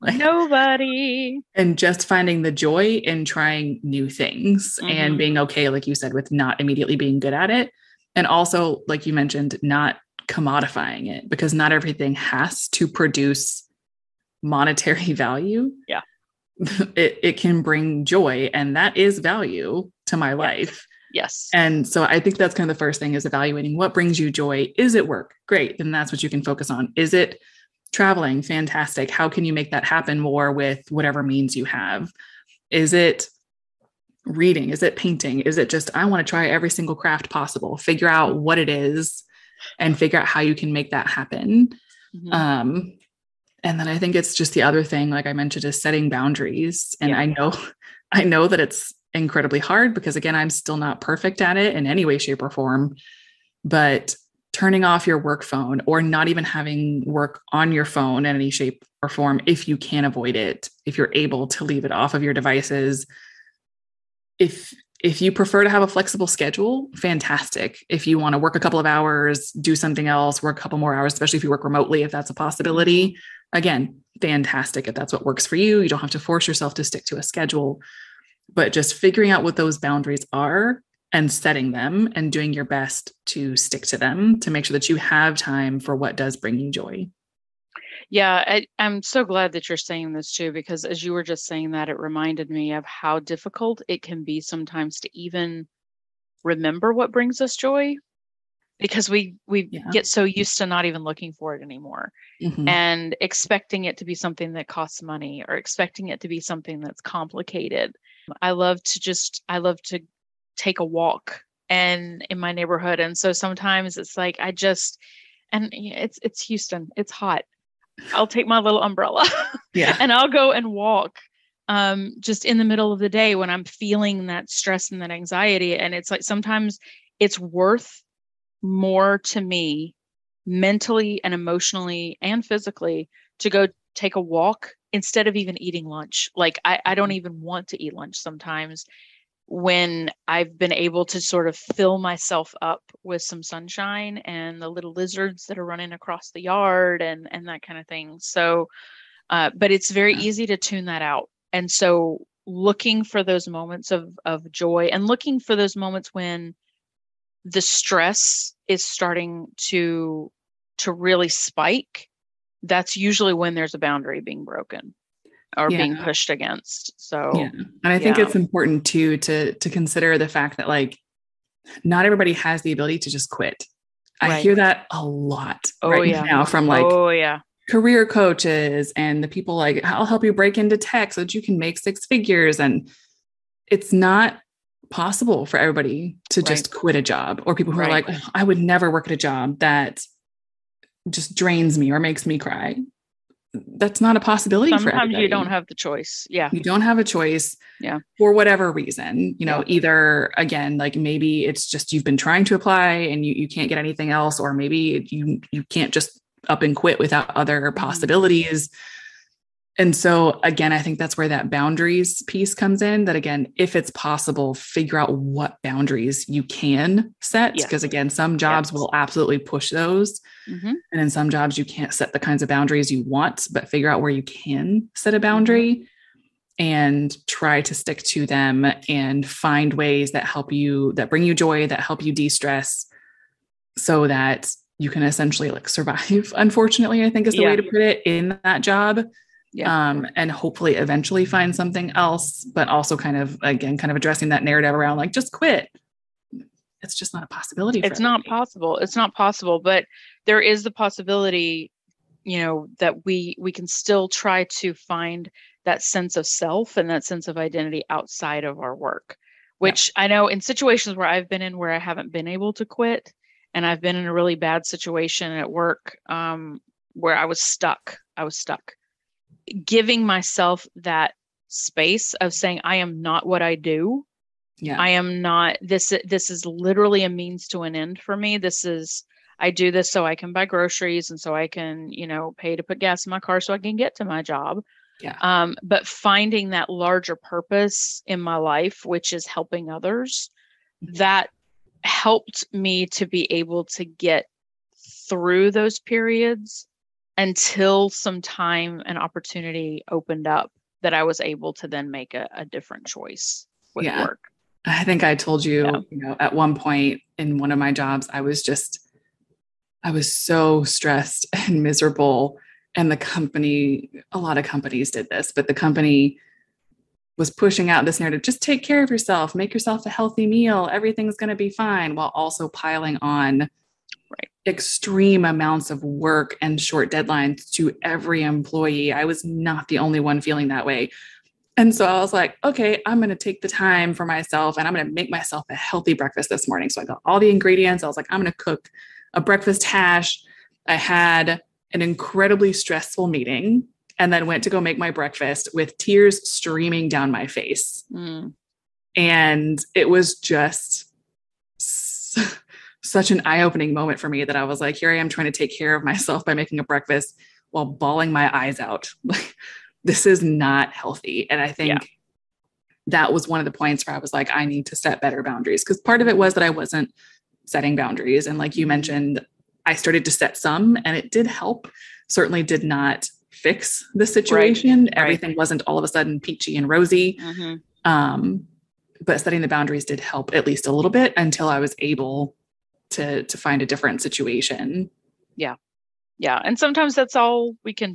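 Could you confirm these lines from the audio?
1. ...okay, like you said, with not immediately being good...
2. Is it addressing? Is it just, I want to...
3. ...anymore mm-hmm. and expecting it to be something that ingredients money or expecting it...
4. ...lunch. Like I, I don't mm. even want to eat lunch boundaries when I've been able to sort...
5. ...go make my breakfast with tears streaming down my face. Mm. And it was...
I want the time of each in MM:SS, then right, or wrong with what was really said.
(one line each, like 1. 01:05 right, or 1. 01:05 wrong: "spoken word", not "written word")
1. 00:05 right
2. 00:34 wrong: "painting", not "addressing"
3. 01:41 wrong: "costs", not "ingredients"
4. 02:15 wrong: "sometimes", not "boundaries"
5. 05:44 right.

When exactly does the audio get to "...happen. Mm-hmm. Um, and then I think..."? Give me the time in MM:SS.
00:41.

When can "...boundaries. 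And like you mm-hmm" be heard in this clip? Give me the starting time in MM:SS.
06:07.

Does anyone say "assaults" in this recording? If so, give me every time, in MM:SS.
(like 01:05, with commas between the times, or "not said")
not said.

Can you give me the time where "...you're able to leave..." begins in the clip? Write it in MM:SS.
01:00.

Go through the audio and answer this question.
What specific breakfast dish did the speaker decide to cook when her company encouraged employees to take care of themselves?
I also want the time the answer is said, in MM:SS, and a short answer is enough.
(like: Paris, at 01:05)
breakfast hash, at 05:39.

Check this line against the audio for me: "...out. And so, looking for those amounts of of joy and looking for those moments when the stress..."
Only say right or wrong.
wrong.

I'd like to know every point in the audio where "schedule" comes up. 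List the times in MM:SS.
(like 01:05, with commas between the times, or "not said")
01:06, 01:17.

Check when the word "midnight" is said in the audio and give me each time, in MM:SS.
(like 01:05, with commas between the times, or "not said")
not said.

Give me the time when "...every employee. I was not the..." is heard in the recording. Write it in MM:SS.
05:27.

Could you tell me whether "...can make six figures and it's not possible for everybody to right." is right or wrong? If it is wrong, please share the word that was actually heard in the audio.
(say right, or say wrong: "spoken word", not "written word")
right.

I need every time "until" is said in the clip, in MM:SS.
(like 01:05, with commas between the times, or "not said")
04:57, 06:21.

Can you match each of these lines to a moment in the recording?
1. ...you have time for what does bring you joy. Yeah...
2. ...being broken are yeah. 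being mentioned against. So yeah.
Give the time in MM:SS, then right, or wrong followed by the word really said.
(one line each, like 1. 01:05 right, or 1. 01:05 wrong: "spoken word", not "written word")
1. 01:24 right
2. 02:44 wrong: "pushed", not "mentioned".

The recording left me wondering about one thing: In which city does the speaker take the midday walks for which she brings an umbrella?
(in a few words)
Houston.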